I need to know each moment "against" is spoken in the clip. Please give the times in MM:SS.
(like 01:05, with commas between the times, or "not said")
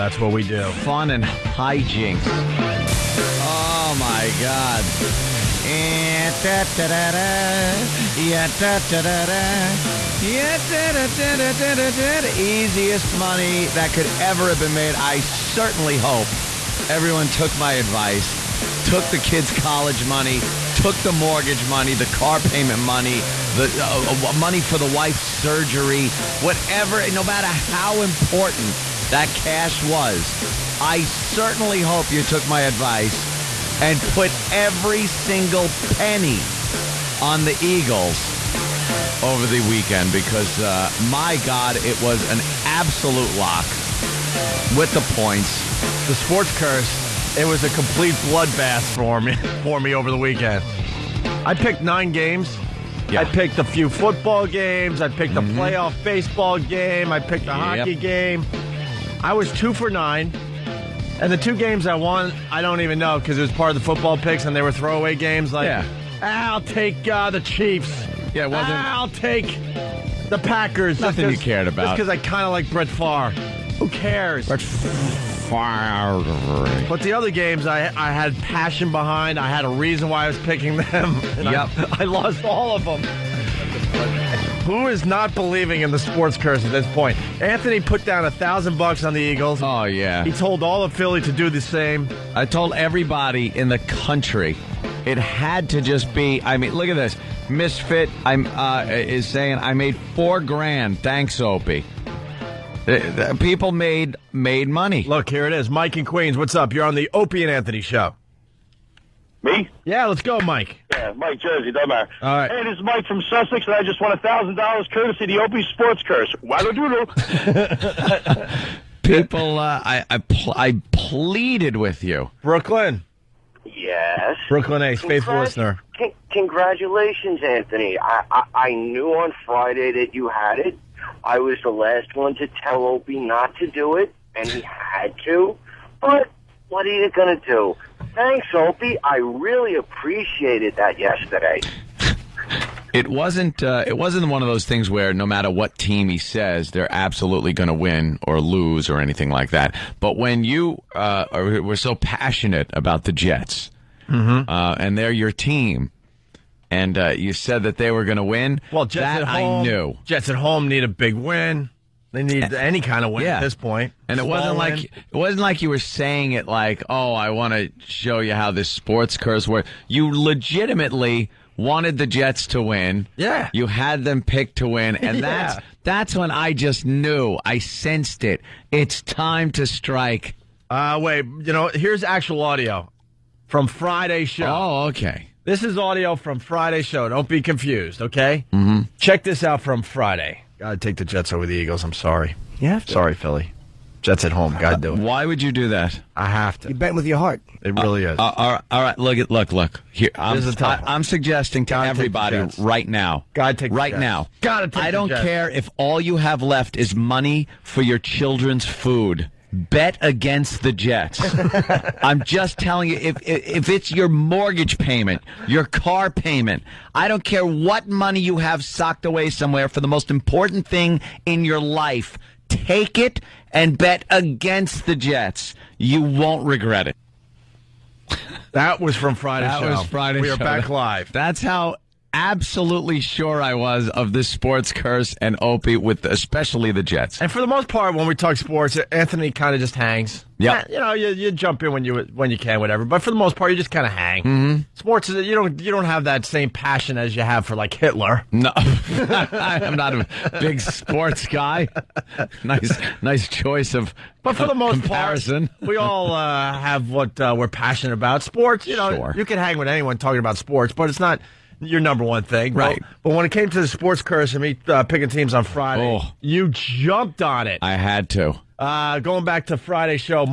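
03:30, 03:44.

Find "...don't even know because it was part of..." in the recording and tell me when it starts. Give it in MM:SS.
01:02.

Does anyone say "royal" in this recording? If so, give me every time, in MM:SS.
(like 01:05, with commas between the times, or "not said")
not said.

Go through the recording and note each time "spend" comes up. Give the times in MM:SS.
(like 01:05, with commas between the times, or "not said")
not said.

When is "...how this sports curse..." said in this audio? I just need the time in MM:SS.
02:48.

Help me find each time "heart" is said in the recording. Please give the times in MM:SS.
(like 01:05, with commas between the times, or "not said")
03:17.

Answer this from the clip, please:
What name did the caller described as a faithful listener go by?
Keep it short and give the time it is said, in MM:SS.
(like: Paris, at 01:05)
Brooklyn Ace, at 02:04.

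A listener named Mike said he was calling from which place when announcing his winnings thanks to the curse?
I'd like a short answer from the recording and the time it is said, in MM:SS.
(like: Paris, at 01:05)
Sussex, at 01:53.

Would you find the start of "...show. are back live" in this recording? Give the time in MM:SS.
03:50.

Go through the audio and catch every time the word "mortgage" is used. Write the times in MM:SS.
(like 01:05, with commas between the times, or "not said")
00:21, 03:34.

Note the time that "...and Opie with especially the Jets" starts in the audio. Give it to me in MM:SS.
03:55.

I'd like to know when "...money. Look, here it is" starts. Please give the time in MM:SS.
01:44.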